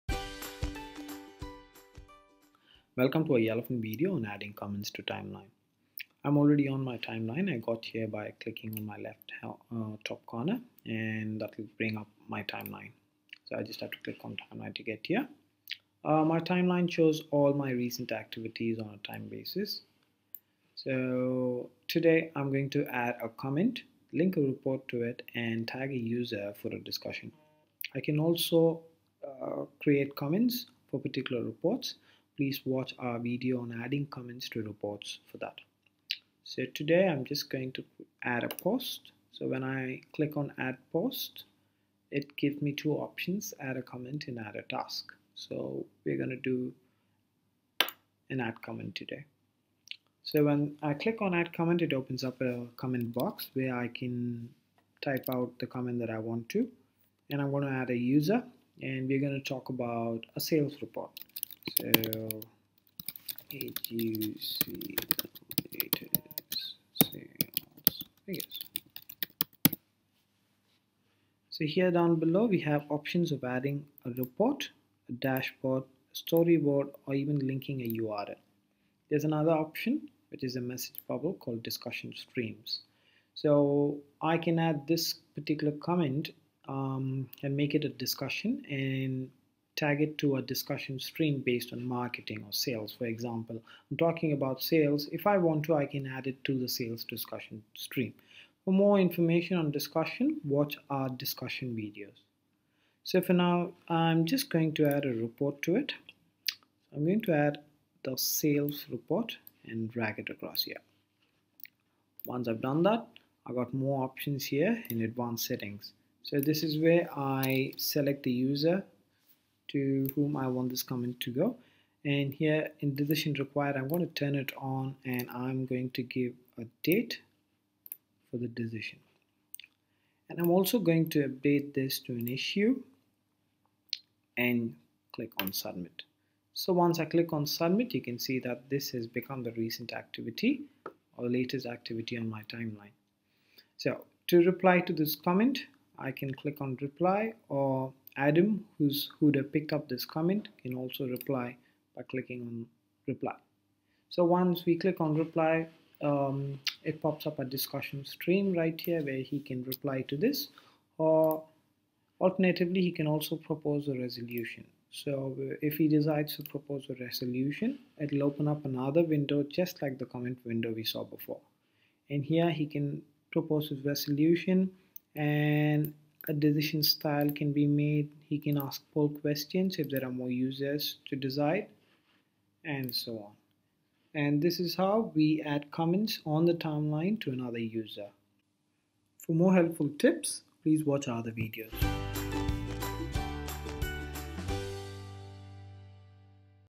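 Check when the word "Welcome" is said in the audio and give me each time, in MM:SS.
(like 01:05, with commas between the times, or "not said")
00:02.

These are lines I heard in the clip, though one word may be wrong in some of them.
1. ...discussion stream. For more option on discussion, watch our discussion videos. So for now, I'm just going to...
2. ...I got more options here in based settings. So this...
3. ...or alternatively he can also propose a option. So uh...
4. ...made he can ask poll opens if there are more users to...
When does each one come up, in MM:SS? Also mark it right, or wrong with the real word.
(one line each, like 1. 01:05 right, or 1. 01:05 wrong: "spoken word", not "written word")
1. 01:37 wrong: "information", not "option"
2. 01:53 wrong: "advanced", not "based"
3. 02:40 wrong: "resolution", not "option"
4. 02:57 wrong: "questions", not "opens".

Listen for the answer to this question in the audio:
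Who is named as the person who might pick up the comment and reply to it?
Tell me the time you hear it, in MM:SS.
02:28.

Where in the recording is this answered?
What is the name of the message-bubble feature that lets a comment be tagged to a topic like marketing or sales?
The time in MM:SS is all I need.
01:21.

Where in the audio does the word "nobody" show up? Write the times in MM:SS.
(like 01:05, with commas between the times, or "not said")
not said.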